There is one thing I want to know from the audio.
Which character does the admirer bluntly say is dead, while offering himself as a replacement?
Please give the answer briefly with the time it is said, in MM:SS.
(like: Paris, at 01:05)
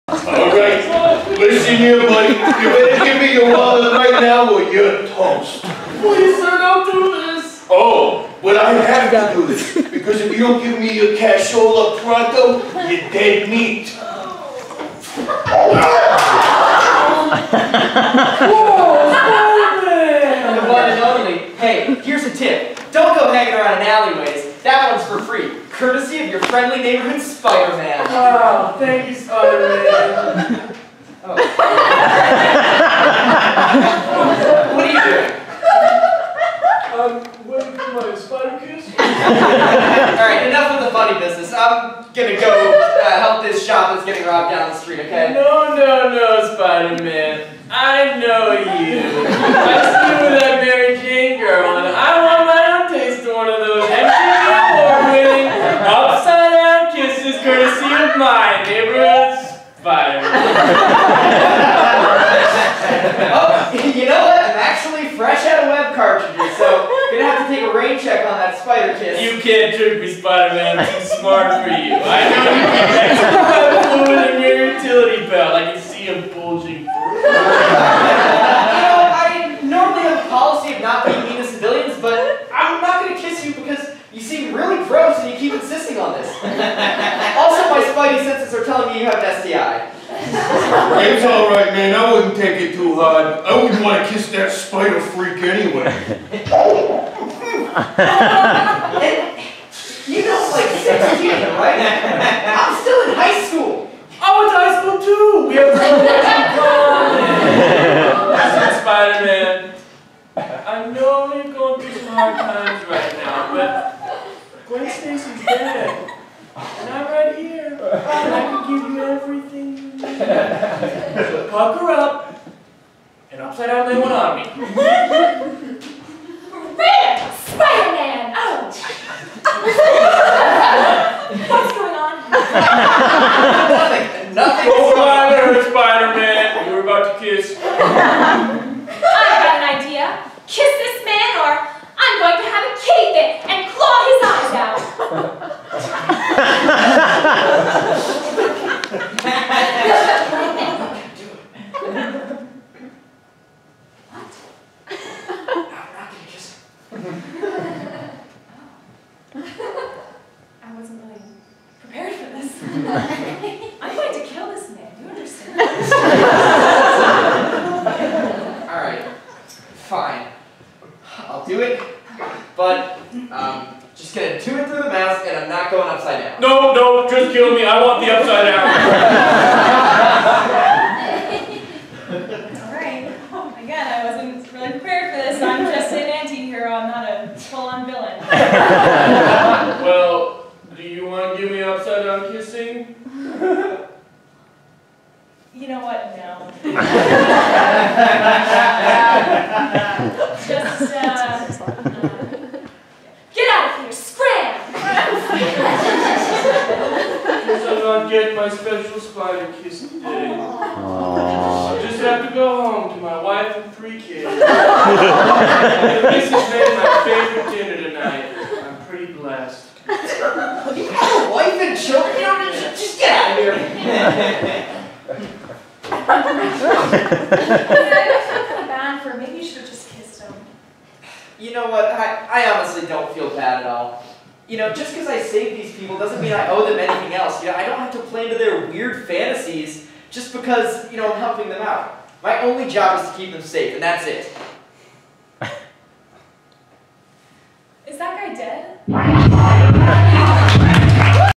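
Gwen Stacy, at 01:54.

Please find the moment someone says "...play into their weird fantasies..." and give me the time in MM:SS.
03:57.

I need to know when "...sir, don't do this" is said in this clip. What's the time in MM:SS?
00:06.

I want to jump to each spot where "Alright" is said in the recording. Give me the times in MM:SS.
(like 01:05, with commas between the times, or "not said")
02:45, 03:02.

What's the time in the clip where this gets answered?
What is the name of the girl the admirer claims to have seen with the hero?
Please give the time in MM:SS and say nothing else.
00:50.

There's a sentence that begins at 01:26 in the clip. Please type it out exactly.
also, my spidey senses are telling me you have an STI.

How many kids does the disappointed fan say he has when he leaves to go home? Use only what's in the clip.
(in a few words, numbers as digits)
3.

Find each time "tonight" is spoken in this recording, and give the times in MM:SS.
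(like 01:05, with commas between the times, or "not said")
03:37.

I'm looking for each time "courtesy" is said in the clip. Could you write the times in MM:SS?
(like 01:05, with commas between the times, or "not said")
00:25, 00:57.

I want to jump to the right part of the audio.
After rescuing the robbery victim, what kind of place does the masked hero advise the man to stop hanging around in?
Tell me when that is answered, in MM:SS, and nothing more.
00:23.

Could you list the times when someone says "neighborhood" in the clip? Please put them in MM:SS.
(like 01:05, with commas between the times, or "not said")
00:26, 00:58.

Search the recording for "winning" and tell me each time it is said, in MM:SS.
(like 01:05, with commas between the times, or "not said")
00:54.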